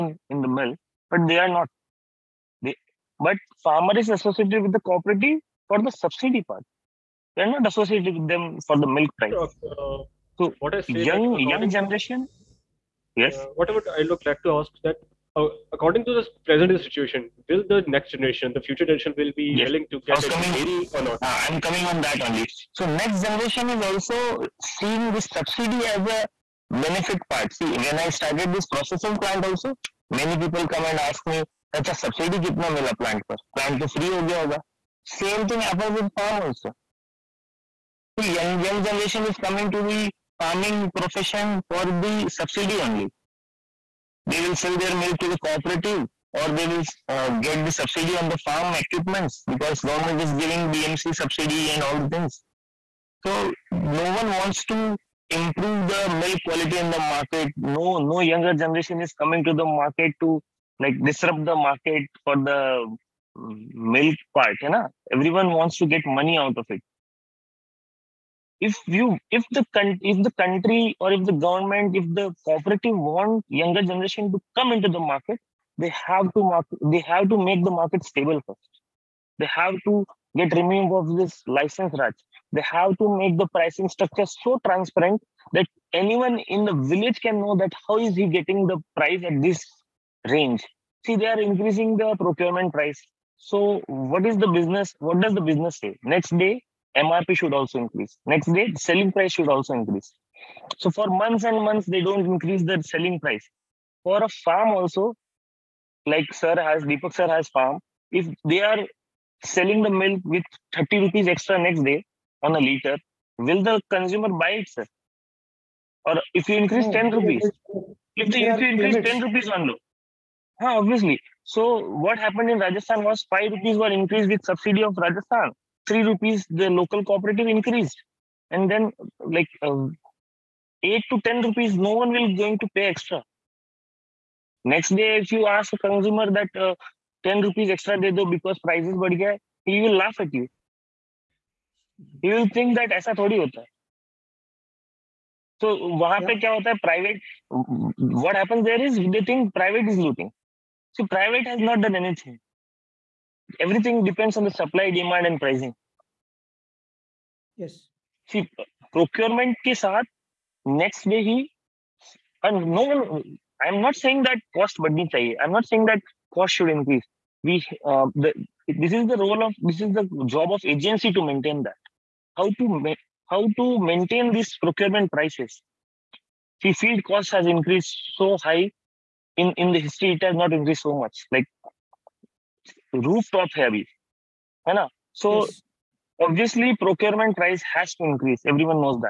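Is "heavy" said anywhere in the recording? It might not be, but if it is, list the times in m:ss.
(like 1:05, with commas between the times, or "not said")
3:03.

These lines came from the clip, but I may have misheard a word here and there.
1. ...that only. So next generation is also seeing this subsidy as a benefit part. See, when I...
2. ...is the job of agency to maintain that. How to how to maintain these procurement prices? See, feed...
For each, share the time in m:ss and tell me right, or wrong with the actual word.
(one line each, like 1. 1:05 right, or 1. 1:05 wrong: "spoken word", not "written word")
1. 0:22 right
2. 2:49 right.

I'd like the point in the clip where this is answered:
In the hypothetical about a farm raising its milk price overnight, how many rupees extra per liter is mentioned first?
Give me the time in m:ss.
1:50.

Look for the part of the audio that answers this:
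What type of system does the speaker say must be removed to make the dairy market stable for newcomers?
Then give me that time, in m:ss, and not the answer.
1:21.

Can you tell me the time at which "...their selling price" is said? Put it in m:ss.
1:42.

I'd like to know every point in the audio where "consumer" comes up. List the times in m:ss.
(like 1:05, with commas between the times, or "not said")
1:53, 2:15.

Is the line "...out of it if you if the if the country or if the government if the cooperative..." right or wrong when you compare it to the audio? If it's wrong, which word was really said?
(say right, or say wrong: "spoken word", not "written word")
right.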